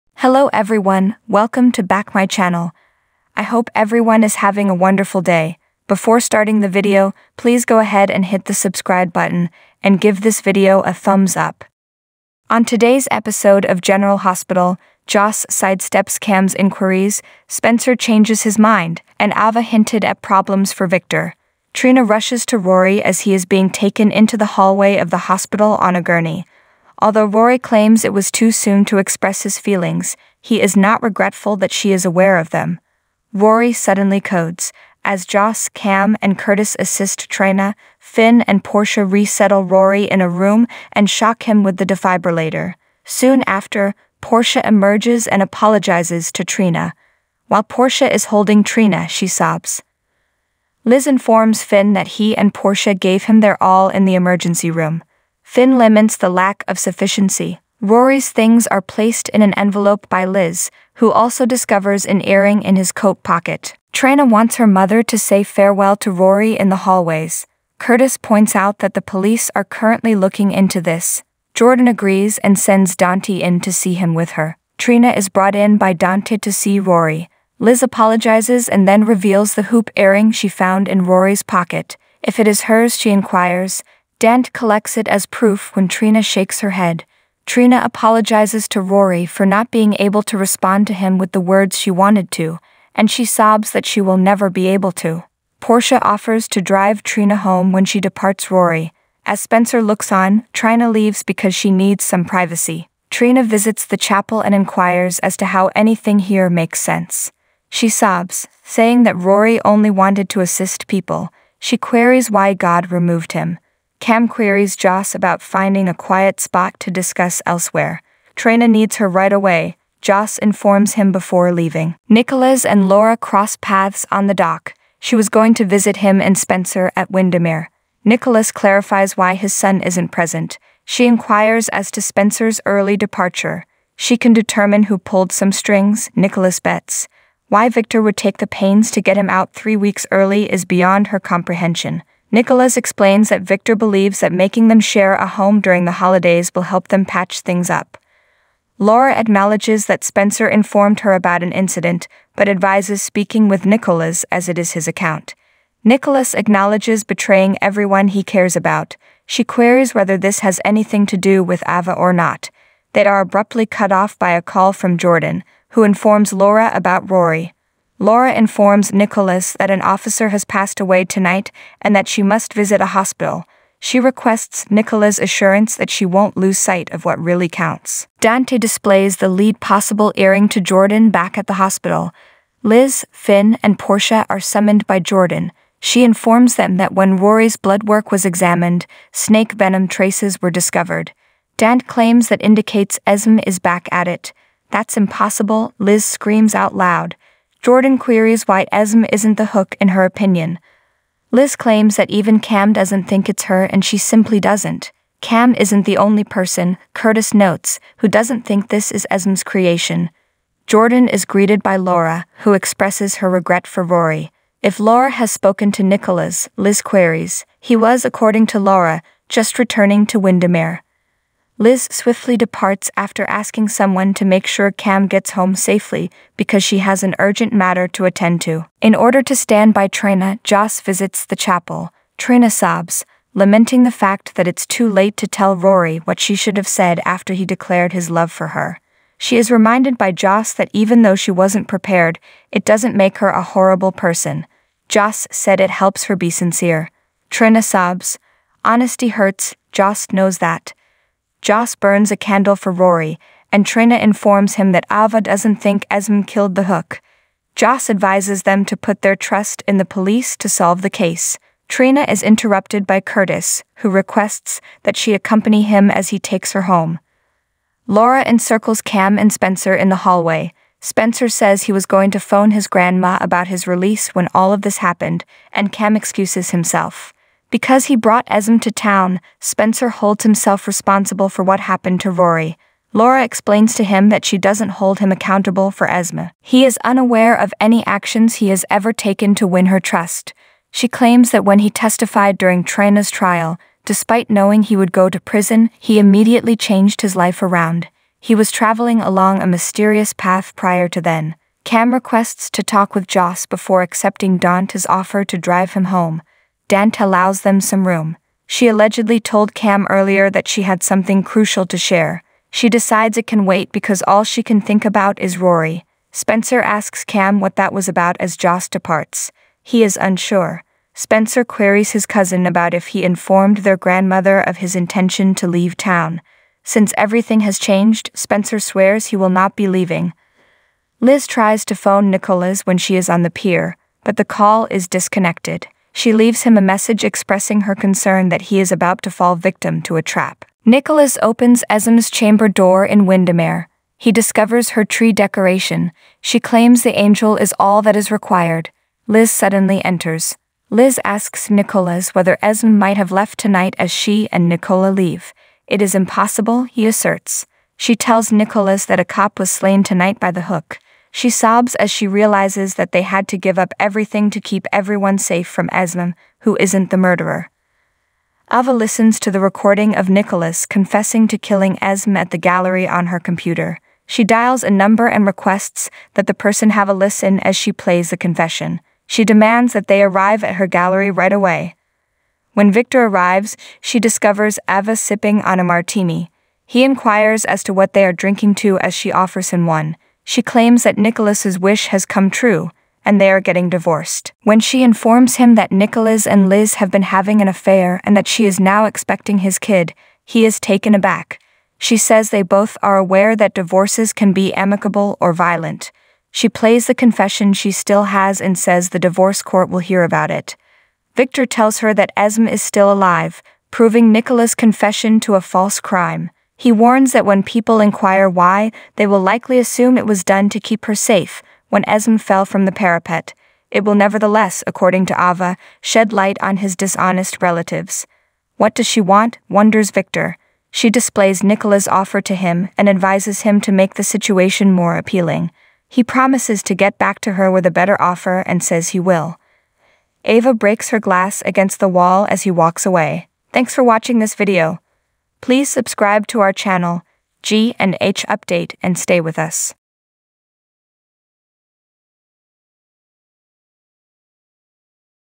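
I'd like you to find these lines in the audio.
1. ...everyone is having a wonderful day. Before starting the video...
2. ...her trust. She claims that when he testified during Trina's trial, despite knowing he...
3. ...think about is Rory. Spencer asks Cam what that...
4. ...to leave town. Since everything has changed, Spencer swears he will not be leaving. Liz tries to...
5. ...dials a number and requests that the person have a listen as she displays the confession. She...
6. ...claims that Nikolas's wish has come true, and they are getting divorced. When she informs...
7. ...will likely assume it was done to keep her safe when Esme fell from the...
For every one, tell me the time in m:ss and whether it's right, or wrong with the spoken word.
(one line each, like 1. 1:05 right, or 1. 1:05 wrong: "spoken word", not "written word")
1. 0:03 right
2. 4:49 right
3. 5:14 right
4. 5:25 right
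5. 6:14 wrong: "plays", not "displays"
6. 6:30 right
7. 6:59 right.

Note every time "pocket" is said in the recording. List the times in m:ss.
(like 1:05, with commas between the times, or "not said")
1:03, 1:21.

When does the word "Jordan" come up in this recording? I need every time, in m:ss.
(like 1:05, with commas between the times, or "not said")
1:11, 2:44, 3:00, 3:04, 3:17, 3:30.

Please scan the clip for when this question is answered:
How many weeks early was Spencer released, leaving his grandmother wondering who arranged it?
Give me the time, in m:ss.
2:19.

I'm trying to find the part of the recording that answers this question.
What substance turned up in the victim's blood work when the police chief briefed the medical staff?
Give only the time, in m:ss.
3:09.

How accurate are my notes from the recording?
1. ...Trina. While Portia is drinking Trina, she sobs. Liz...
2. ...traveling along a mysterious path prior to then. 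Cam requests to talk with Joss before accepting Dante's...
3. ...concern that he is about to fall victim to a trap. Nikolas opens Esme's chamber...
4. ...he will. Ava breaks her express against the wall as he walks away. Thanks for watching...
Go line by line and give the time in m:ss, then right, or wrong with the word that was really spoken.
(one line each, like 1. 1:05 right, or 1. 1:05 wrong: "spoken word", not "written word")
1. 0:46 wrong: "holding", not "drinking"
2. 4:58 right
3. 5:37 right
4. 7:18 wrong: "glass", not "express".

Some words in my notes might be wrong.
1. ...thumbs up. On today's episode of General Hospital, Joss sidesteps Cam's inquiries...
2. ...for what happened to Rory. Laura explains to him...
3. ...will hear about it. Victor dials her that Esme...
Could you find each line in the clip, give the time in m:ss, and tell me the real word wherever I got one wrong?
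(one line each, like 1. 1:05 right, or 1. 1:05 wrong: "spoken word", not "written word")
1. 0:10 right
2. 4:41 right
3. 6:49 wrong: "tells", not "dials".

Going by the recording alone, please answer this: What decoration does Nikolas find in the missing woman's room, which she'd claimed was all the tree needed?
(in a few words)
angel.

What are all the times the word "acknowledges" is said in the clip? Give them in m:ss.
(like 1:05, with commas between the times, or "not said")
2:29, 2:36.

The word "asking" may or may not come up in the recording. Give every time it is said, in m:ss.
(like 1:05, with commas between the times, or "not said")
3:43.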